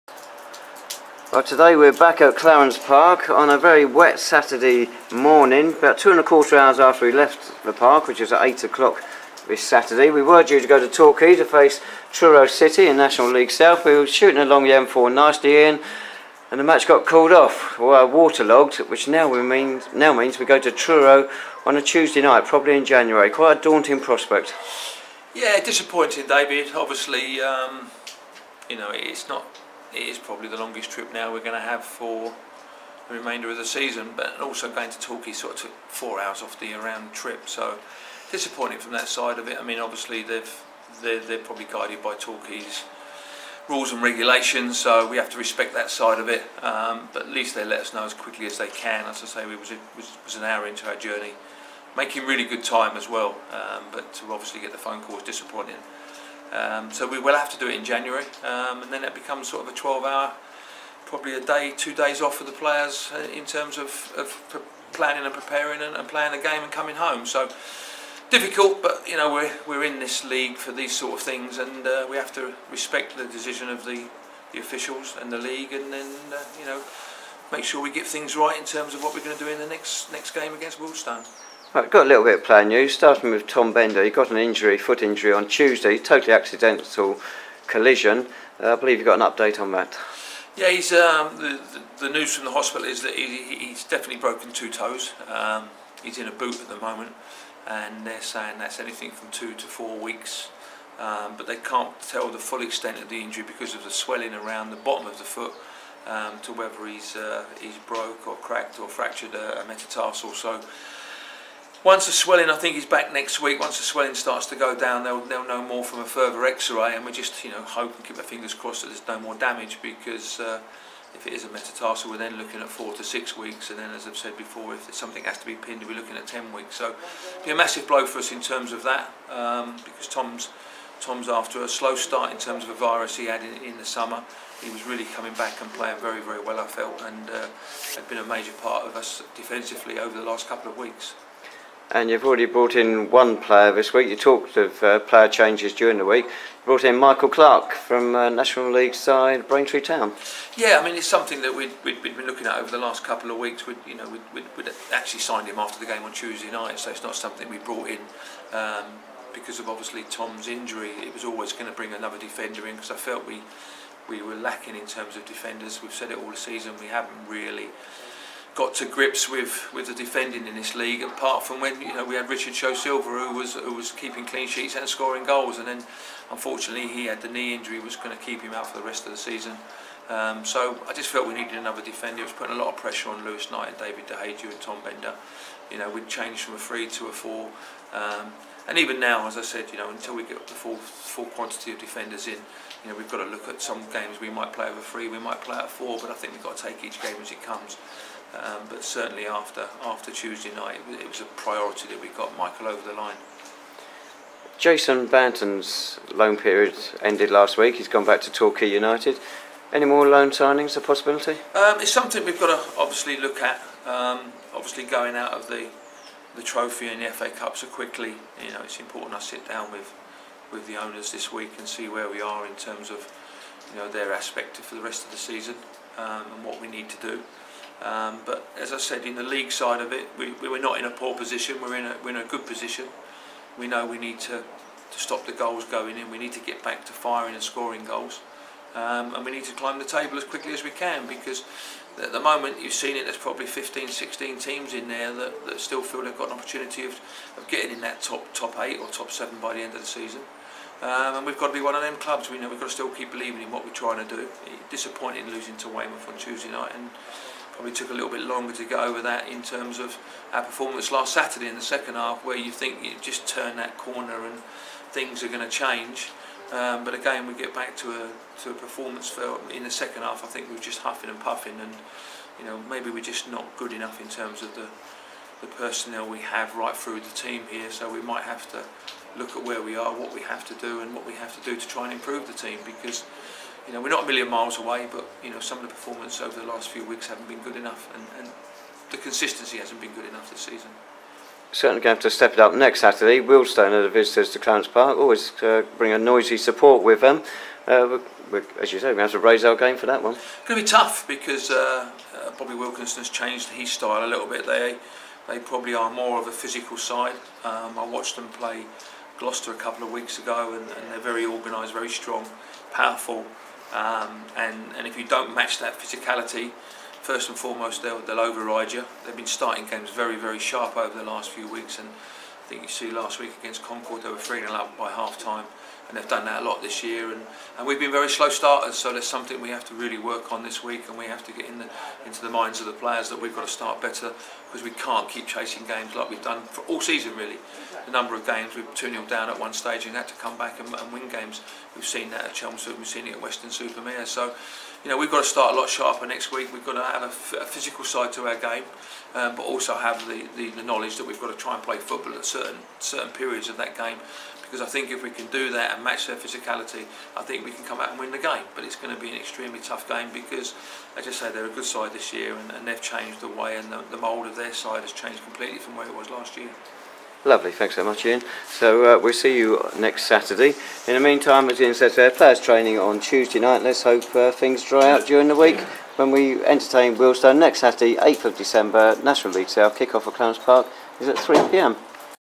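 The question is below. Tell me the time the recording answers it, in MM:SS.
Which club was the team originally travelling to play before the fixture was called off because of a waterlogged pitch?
00:12.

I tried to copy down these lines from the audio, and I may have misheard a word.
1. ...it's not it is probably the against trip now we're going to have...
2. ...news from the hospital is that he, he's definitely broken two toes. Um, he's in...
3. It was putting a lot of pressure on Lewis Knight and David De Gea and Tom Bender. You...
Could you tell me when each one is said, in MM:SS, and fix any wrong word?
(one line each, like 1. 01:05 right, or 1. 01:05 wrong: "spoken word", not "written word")
1. 00:28 wrong: "longest", not "against"
2. 01:32 right
3. 03:02 right.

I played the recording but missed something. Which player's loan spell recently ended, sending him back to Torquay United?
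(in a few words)
Jason Banton.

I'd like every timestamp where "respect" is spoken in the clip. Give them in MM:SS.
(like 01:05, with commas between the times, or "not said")
00:45, 01:12.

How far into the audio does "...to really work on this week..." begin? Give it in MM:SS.
05:29.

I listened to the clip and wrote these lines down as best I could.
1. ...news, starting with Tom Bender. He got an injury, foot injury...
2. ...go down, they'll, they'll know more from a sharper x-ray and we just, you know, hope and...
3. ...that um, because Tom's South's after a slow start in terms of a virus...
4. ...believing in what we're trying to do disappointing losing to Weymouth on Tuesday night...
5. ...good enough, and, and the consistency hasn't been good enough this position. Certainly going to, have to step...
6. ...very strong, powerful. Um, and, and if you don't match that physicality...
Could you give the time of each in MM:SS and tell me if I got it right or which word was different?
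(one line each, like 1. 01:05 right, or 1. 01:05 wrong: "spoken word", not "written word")
1. 01:22 right
2. 01:54 wrong: "further", not "sharper"
3. 02:08 wrong: "Tom", not "South"
4. 04:13 right
5. 04:47 wrong: "season", not "position"
6. 05:11 right.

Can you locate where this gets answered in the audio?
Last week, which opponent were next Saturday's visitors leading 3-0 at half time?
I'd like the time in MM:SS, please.
05:23.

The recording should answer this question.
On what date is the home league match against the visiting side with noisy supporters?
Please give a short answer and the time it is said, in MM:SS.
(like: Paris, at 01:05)
8 December, at 06:17.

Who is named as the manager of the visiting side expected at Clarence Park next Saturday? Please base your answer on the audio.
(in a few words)
Bobby Wilkinson.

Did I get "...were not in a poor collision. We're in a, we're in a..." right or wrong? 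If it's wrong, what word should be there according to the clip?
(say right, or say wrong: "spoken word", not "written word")
wrong: "position", not "collision".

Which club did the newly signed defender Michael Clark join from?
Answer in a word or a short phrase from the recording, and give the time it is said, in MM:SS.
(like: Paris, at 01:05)
Braintree Town, at 02:29.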